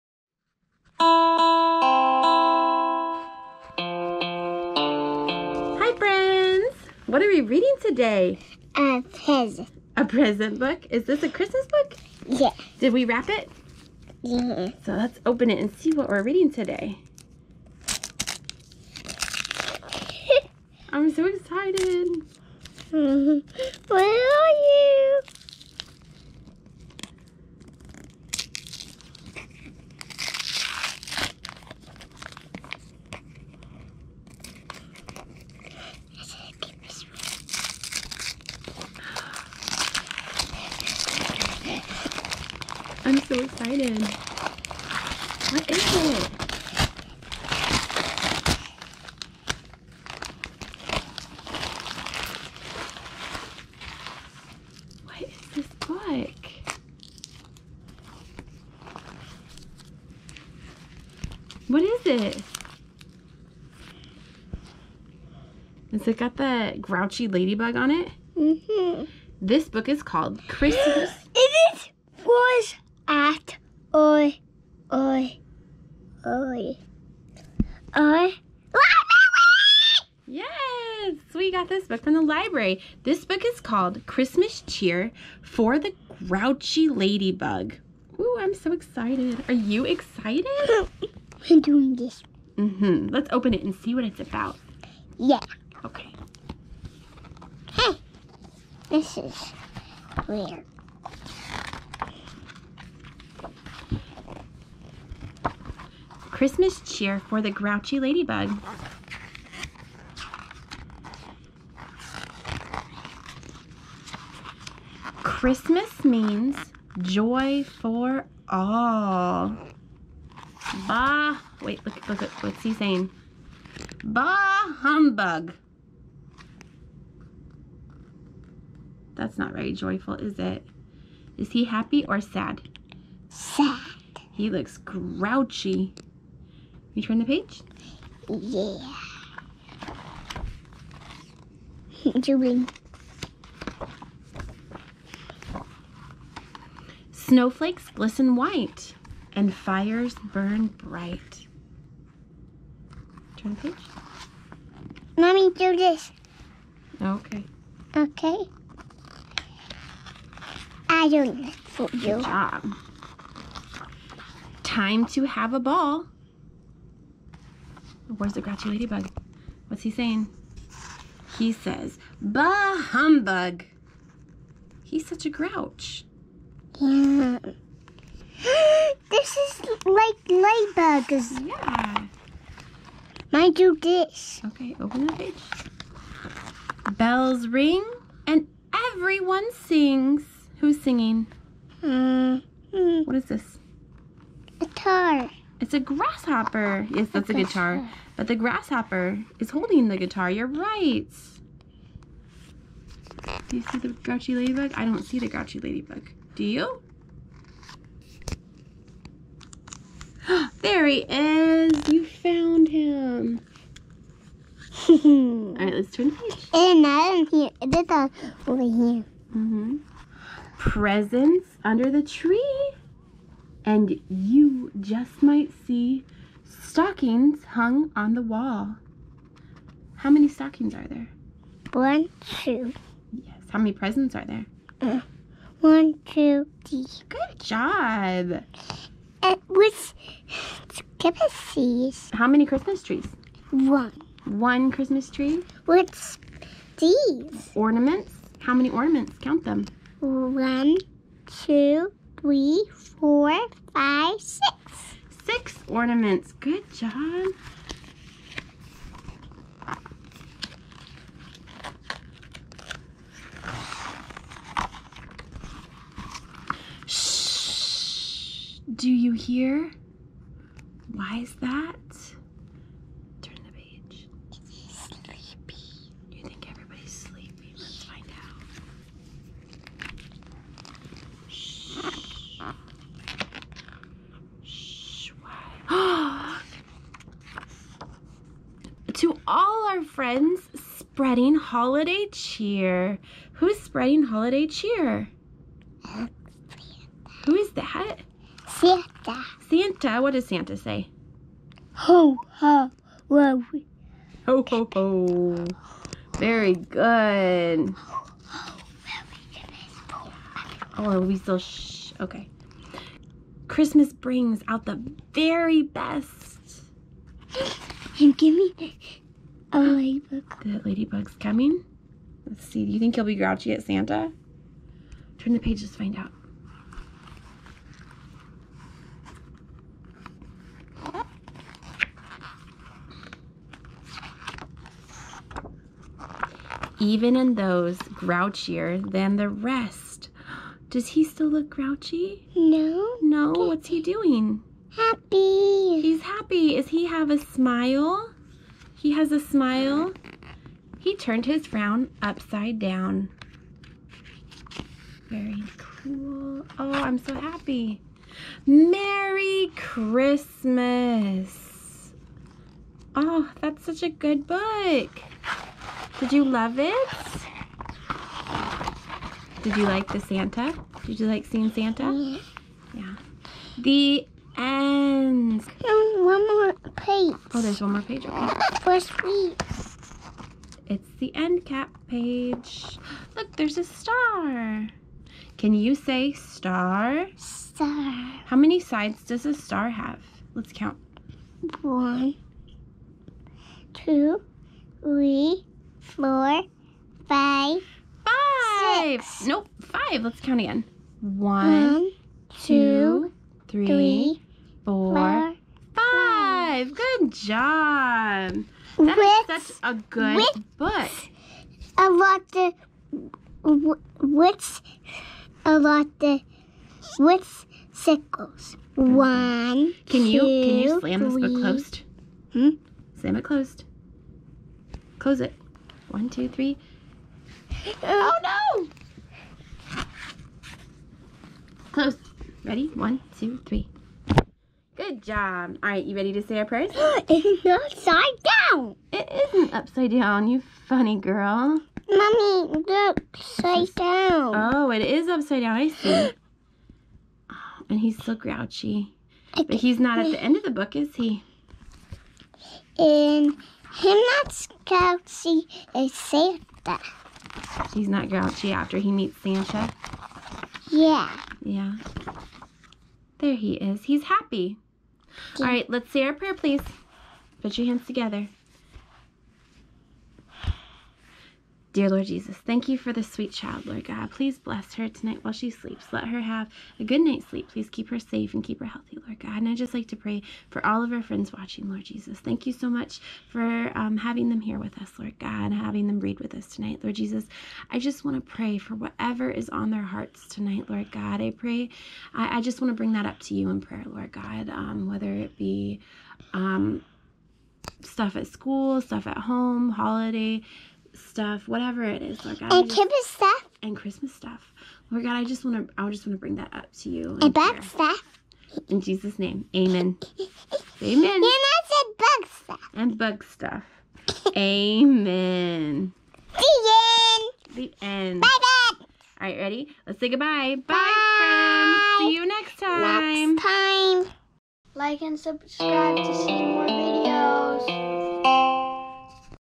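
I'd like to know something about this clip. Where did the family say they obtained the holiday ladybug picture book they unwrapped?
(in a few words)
The library.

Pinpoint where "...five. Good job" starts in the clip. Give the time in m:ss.
6:45.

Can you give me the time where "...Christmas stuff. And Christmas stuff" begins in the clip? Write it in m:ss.
8:22.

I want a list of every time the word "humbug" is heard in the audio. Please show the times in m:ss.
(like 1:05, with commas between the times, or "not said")
2:04, 2:52.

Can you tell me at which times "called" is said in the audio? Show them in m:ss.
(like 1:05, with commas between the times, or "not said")
1:10, 1:23.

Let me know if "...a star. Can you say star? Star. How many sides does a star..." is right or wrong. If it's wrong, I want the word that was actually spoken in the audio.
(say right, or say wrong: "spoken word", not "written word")
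right.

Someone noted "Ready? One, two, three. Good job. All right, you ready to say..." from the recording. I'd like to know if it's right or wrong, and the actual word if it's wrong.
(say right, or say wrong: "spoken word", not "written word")
right.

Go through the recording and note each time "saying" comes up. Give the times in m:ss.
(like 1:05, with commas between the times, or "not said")
2:02, 2:49.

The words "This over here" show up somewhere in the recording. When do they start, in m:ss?
3:37.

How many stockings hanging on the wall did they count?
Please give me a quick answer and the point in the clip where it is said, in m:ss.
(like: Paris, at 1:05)
2, at 3:51.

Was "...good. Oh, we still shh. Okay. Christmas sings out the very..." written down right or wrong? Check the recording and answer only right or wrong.
wrong.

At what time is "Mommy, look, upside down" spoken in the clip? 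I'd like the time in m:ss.
7:21.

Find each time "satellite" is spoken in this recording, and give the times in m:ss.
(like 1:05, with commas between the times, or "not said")
not said.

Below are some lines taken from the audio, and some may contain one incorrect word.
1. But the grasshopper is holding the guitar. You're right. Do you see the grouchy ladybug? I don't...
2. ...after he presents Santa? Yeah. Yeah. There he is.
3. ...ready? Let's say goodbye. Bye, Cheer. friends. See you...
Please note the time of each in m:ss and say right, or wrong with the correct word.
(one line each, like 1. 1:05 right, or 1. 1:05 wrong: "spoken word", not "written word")
1. 3:18 right
2. 7:38 wrong: "meets", not "presents"
3. 8:39 wrong: "Bye", not "Cheer".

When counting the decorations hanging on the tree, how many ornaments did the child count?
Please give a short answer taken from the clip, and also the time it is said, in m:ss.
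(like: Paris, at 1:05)
6, at 4:15.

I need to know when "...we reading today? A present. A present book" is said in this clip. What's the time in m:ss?
0:07.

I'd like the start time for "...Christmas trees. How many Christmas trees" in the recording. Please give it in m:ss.
4:00.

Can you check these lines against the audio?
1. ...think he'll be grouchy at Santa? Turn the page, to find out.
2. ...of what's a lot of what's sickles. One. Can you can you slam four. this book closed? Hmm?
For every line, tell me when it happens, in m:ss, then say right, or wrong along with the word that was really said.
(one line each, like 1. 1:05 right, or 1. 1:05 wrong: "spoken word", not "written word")
1. 5:22 right
2. 6:52 wrong: "three", not "four".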